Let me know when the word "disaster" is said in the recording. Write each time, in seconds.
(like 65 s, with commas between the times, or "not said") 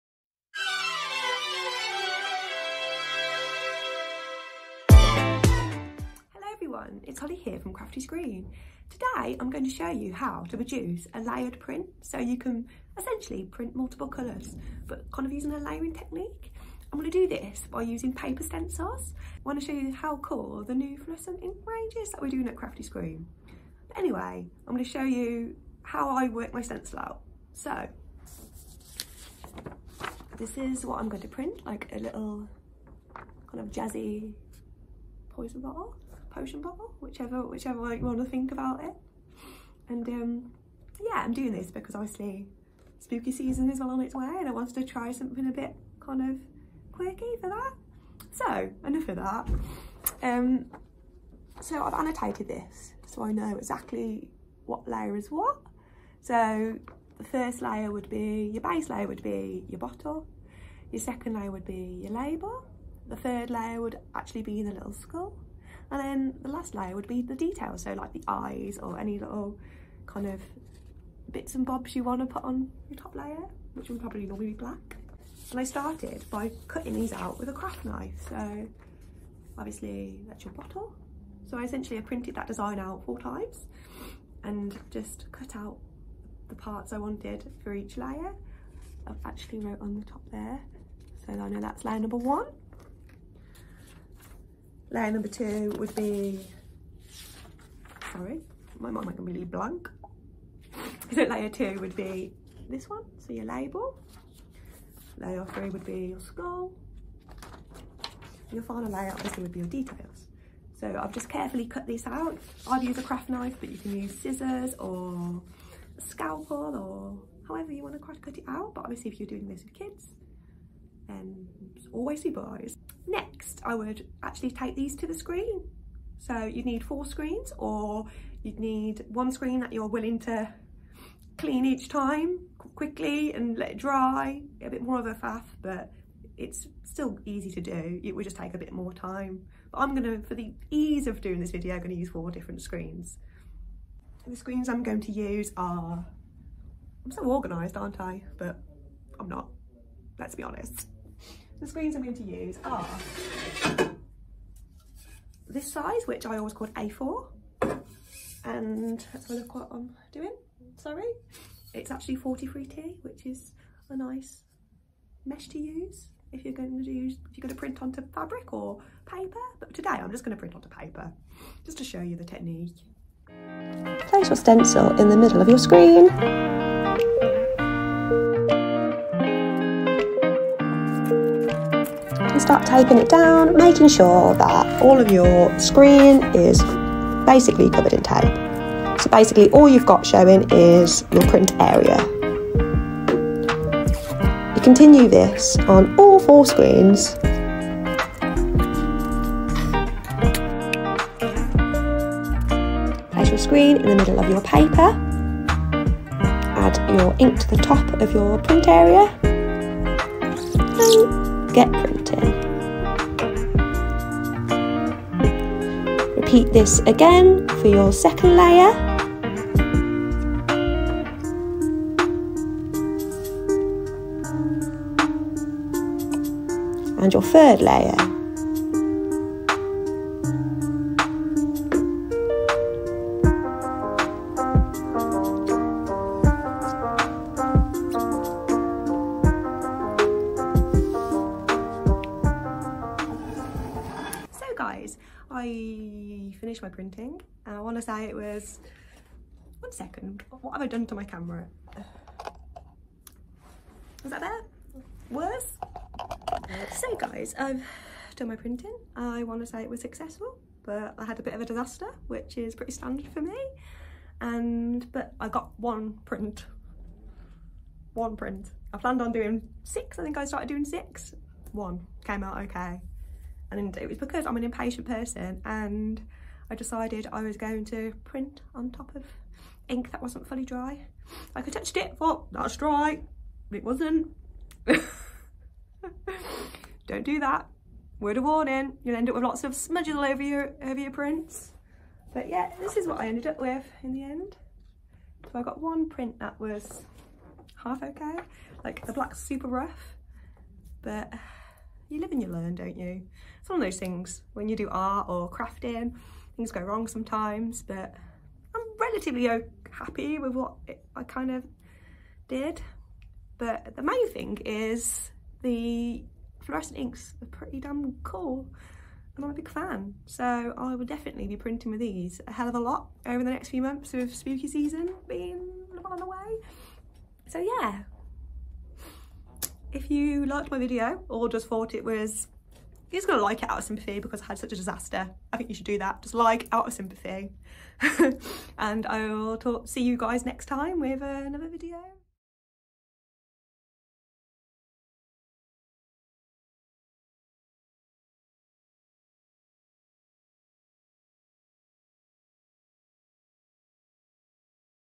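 261 s, 334 s.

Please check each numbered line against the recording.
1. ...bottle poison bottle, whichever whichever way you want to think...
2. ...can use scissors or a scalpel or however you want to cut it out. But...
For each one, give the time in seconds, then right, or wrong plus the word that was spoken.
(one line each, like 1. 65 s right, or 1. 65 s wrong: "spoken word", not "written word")
1. 35 s wrong: "potion", not "poison"
2. 113 s right.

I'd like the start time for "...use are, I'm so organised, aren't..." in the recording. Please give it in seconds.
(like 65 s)
145 s.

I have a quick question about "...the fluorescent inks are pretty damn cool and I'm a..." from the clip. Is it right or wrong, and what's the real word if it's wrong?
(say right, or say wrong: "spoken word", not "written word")
right.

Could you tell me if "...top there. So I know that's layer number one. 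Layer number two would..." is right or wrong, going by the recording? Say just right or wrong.
right.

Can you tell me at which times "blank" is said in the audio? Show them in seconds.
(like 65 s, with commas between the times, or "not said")
99 s.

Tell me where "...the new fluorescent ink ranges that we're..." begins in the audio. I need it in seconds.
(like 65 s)
20 s.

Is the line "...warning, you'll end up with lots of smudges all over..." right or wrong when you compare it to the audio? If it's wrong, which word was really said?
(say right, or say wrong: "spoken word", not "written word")
right.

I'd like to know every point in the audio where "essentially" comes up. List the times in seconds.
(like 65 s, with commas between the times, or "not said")
12 s, 81 s.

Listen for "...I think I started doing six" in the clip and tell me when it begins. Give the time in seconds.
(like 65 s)
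269 s.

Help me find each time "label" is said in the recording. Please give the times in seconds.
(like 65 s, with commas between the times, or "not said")
62 s, 103 s.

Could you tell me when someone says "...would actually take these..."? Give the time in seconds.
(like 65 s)
123 s.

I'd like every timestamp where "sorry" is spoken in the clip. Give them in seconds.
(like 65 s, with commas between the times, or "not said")
98 s, 160 s.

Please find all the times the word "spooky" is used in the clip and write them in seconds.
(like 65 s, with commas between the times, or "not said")
42 s, 324 s.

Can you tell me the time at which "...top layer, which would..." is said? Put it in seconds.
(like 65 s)
72 s.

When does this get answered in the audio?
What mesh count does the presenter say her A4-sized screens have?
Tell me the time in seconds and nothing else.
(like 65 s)
162 s.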